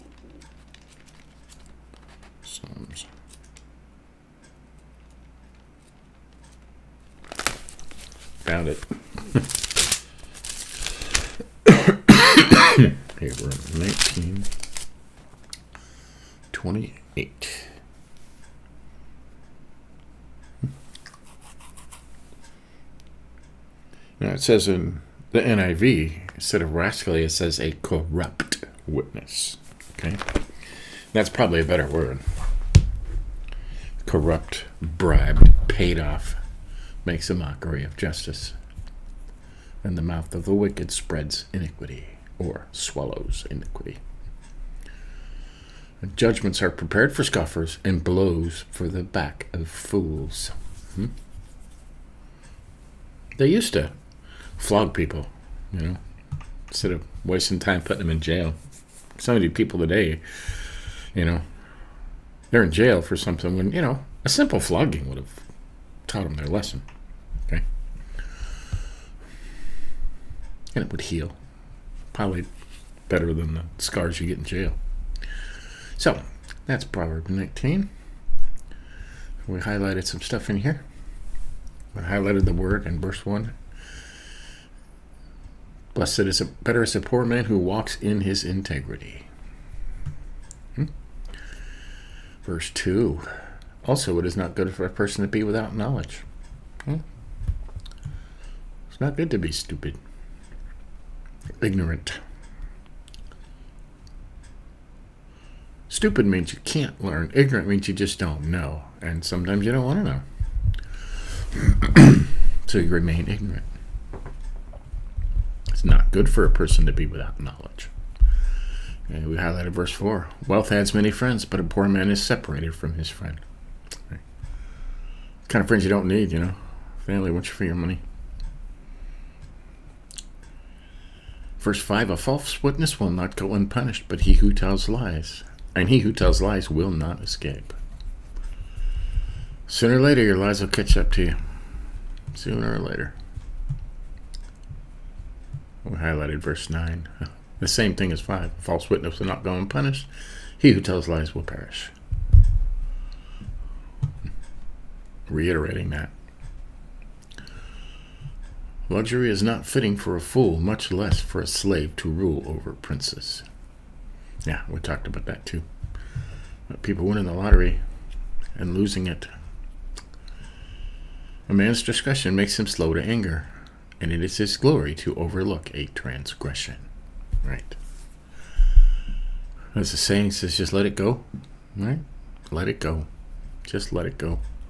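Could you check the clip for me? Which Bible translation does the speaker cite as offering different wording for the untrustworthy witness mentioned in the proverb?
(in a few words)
NIV.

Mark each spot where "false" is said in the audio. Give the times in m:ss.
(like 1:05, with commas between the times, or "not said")
2:12, 2:28.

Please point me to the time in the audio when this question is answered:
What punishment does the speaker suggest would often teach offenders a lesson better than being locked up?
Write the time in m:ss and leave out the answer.
1:04.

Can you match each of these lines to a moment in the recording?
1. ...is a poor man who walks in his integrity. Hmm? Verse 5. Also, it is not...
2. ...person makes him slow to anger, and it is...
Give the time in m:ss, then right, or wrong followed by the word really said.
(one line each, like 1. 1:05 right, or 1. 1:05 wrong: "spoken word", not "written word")
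1. 1:26 wrong: "2", not "5"
2. 2:51 wrong: "discretion", not "person".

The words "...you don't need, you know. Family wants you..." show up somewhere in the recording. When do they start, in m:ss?
2:05.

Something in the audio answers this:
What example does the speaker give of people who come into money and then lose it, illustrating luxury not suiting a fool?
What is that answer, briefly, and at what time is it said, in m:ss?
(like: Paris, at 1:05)
winning the lottery, at 2:47.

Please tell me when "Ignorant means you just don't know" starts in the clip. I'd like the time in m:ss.
1:47.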